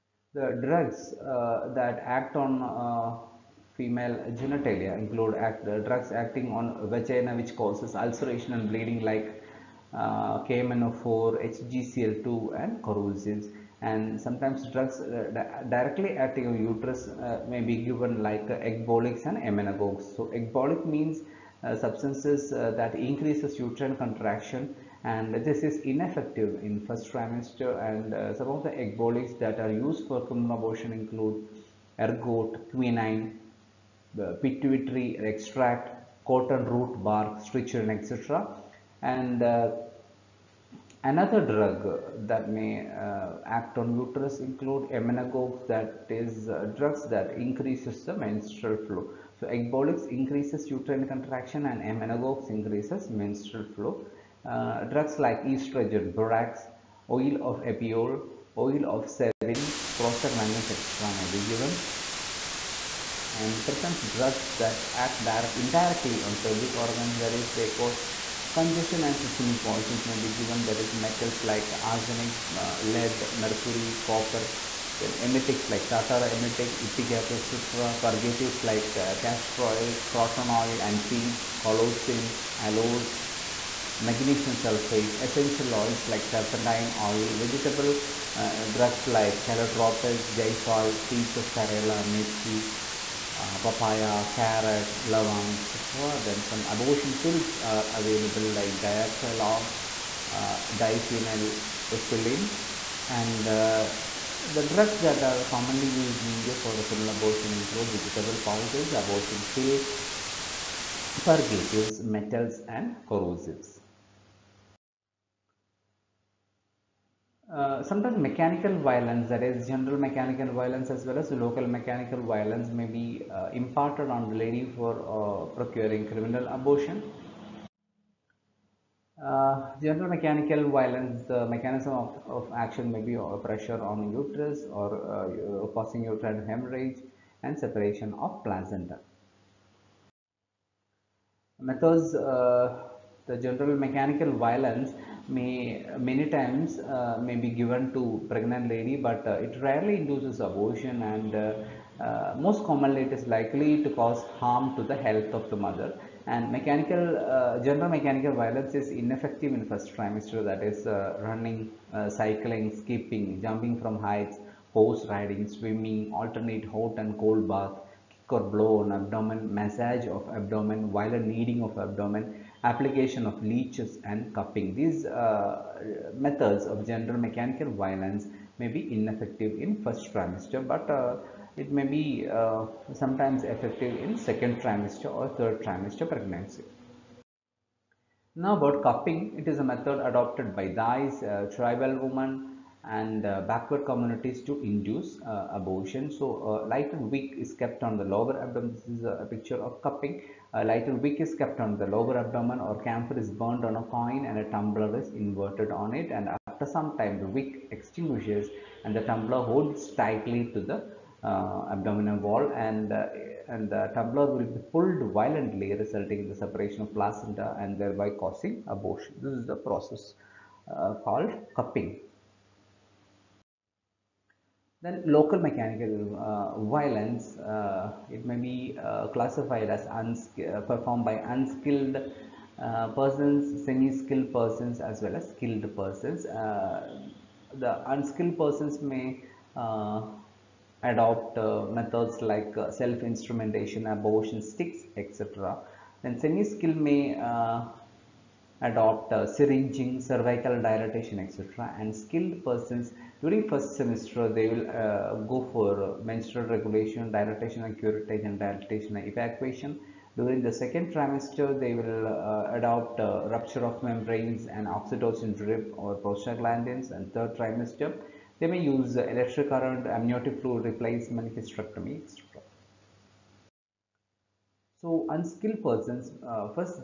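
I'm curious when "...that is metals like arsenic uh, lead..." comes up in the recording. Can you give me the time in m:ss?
1:10.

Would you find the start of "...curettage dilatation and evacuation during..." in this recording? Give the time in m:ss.
4:17.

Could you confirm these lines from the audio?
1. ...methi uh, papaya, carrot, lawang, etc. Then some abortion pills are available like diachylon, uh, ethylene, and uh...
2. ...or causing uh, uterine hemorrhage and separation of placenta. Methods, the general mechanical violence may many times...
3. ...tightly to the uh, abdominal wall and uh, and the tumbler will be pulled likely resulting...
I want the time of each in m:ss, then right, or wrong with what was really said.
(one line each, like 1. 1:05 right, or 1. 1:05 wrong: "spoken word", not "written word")
1. 1:32 right
2. 2:14 right
3. 3:29 wrong: "violently", not "likely".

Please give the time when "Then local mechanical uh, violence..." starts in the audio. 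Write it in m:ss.
3:44.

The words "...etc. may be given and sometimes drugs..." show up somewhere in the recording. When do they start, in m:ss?
1:00.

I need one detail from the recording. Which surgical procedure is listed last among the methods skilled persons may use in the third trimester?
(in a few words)
Hysterectomy.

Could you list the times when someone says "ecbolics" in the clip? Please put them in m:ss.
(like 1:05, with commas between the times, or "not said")
0:20, 0:28, 0:49.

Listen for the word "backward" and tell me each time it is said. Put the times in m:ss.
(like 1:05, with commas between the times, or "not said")
3:13.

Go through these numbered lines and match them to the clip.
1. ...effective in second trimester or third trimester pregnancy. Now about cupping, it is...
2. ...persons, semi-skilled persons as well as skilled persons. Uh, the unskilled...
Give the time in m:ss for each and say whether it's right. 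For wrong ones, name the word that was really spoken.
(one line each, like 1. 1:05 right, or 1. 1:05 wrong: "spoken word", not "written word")
1. 3:03 right
2. 3:52 right.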